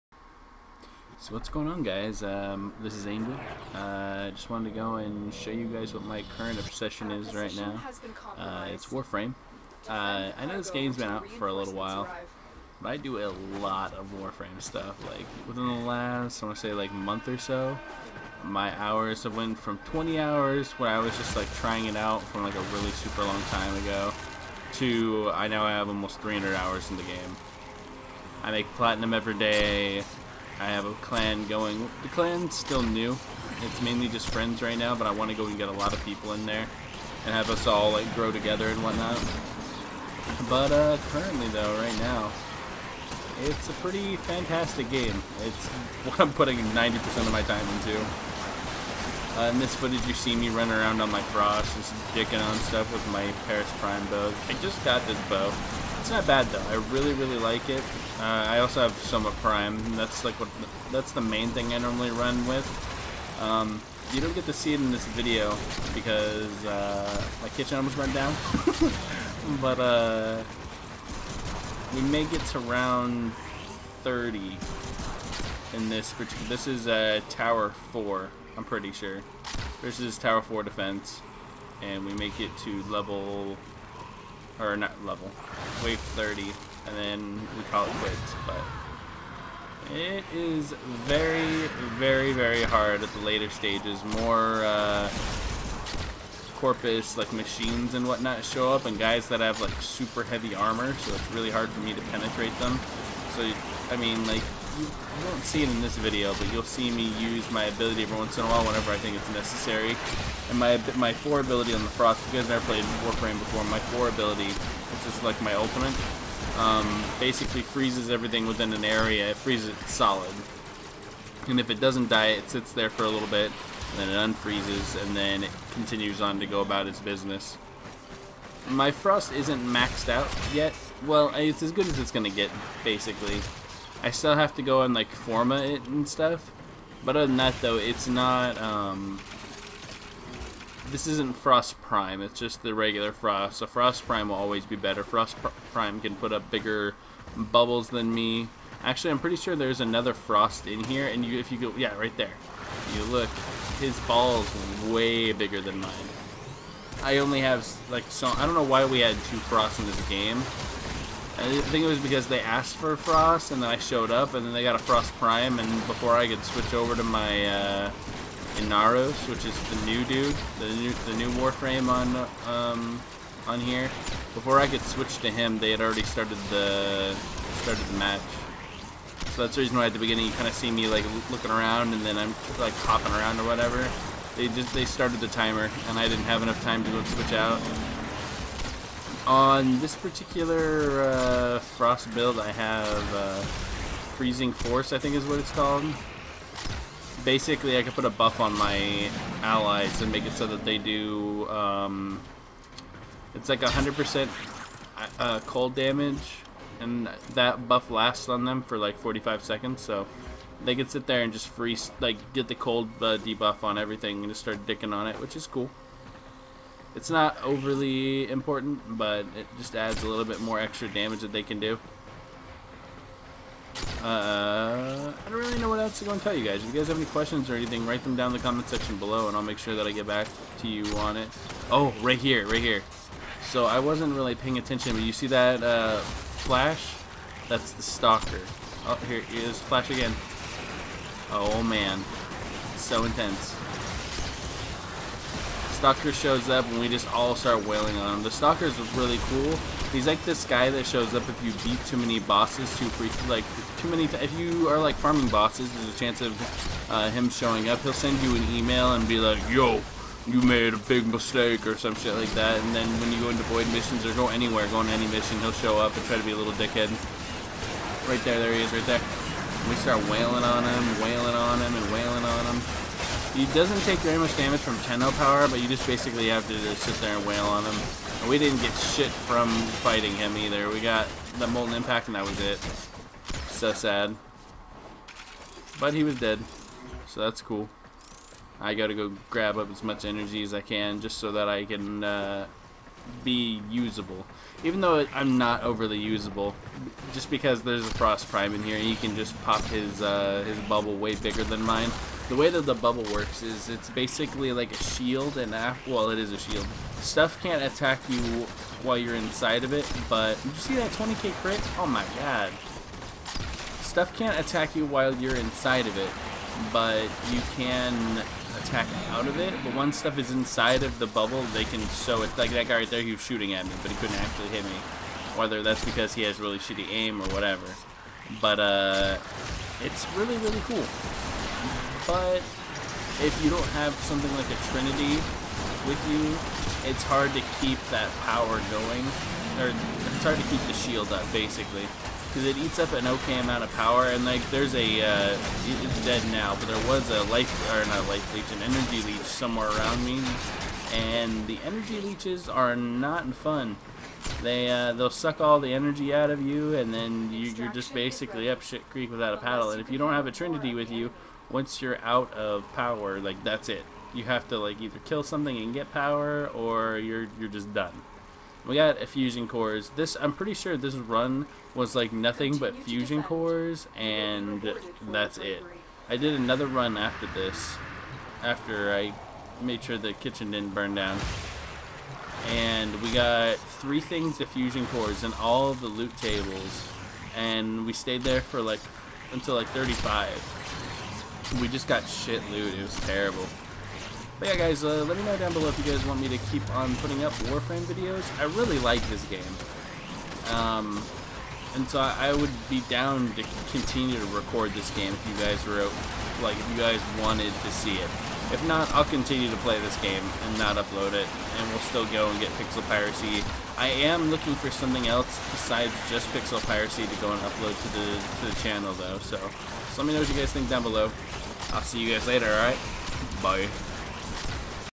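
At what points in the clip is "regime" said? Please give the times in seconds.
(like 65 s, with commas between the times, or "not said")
not said.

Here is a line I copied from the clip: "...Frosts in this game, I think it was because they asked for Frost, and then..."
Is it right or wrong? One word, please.
right.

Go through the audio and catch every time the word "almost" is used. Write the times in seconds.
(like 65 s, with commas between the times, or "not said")
25 s, 67 s.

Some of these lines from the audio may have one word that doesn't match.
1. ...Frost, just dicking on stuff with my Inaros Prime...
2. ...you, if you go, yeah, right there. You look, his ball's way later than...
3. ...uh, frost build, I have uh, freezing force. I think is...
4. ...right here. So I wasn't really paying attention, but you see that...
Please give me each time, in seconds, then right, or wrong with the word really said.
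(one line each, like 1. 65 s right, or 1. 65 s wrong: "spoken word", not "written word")
1. 51 s wrong: "Paris", not "Inaros"
2. 151 s wrong: "bigger", not "later"
3. 191 s right
4. 232 s right.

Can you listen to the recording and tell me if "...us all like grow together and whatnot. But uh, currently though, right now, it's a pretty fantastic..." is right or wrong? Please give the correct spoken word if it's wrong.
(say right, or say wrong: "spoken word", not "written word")
right.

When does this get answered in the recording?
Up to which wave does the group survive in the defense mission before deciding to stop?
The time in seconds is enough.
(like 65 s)
85 s.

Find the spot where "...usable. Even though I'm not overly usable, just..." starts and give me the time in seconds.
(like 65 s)
293 s.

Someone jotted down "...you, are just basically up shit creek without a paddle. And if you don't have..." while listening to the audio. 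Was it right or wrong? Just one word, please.
right.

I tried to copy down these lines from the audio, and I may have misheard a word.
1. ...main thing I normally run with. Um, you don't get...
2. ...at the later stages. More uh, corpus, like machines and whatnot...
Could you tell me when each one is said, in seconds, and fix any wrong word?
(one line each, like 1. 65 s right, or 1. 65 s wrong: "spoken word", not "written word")
1. 61 s right
2. 93 s right.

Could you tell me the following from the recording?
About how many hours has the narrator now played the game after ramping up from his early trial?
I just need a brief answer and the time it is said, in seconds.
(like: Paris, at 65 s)
300 hours, at 26 s.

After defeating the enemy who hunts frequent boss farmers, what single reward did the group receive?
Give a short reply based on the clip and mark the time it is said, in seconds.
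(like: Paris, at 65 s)
Molten Impact, at 281 s.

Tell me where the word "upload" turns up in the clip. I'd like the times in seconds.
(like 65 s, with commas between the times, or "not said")
410 s, 417 s.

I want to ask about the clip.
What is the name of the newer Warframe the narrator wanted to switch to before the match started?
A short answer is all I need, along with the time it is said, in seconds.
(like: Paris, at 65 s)
Inaros, at 168 s.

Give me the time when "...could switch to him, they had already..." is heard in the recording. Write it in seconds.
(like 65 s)
174 s.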